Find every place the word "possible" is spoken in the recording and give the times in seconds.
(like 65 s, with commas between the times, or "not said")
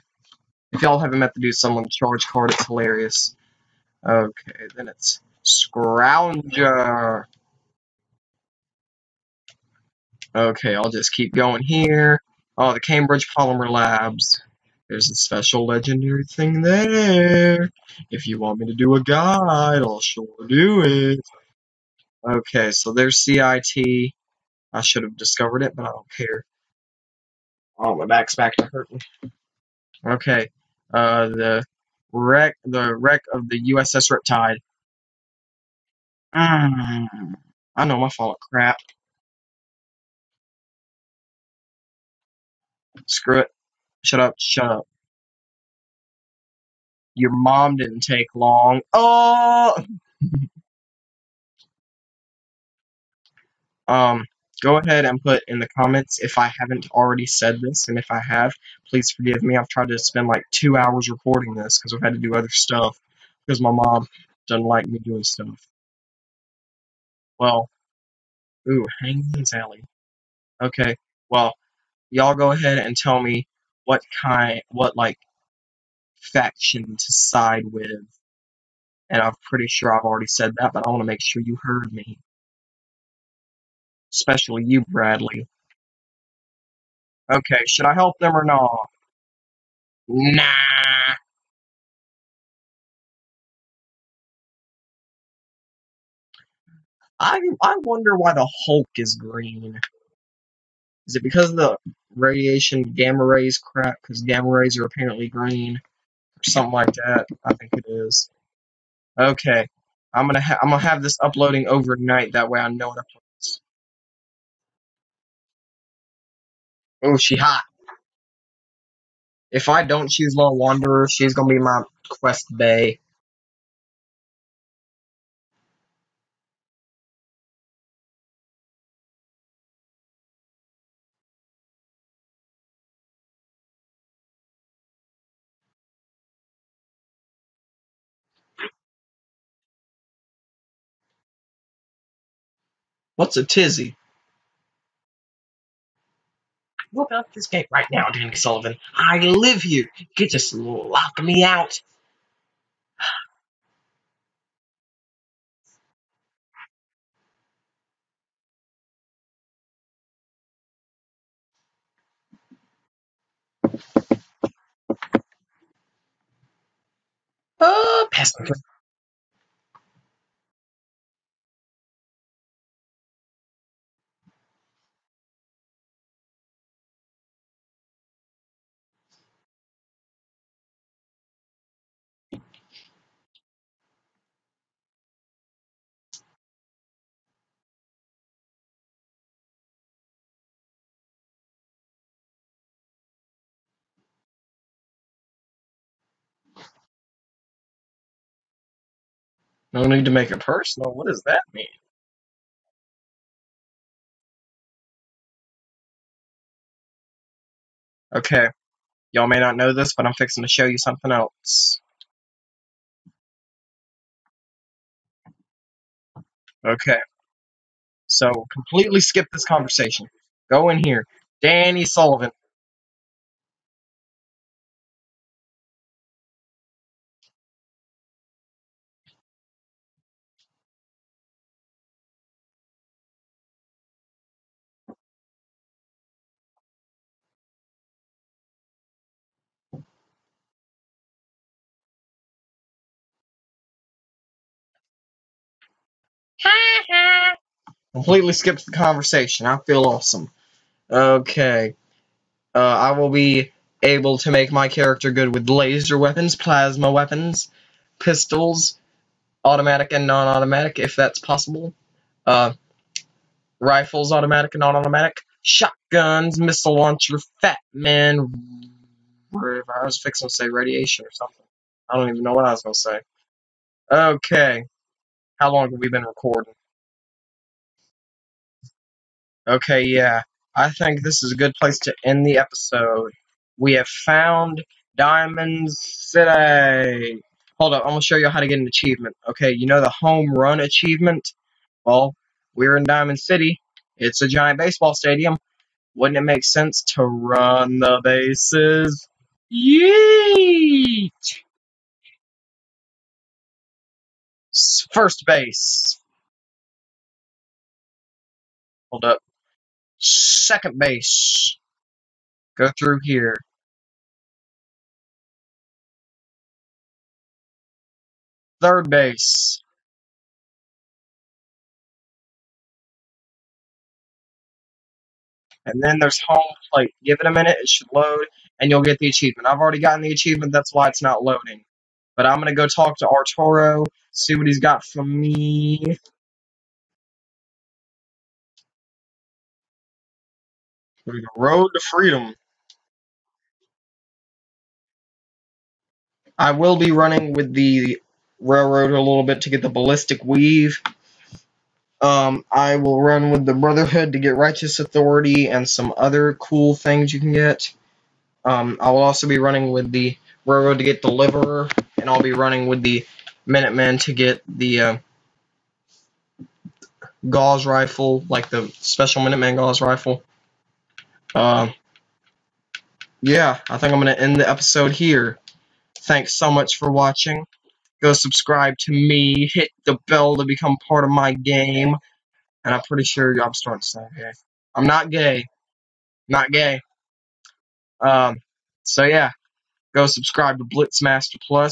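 261 s.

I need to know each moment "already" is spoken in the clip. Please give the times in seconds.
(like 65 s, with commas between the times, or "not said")
56 s, 80 s, 329 s.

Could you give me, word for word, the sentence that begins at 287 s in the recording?
Hold up, I'm gonna show you how to get an achievement.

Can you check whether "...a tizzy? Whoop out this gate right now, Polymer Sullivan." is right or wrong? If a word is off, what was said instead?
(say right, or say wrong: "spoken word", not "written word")
wrong: "Danny", not "Polymer".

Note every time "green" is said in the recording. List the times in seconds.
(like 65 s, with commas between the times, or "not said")
99 s, 105 s.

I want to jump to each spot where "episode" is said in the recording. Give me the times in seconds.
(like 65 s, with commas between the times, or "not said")
282 s, 374 s.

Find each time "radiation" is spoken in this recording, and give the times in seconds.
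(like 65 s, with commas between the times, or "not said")
102 s, 270 s.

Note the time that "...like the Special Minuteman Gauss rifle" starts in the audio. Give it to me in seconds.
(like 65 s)
368 s.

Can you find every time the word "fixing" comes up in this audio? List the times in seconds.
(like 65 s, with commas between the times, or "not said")
210 s, 269 s.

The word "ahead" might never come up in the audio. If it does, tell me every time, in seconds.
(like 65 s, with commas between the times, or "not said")
54 s, 72 s.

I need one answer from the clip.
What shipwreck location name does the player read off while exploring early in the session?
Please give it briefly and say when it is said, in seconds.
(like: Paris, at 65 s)
USS Riptide, at 33 s.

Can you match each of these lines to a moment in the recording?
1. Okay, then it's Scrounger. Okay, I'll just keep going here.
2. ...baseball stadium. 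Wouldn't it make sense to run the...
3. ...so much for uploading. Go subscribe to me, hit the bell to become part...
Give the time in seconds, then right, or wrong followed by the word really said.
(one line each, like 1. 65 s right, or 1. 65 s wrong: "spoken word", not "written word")
1. 4 s right
2. 294 s right
3. 376 s wrong: "watching", not "uploading".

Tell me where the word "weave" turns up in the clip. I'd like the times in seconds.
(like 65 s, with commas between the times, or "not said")
350 s.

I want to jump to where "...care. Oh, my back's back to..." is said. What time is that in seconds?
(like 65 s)
26 s.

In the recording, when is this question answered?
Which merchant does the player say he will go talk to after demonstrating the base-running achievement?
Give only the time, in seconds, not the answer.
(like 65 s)
333 s.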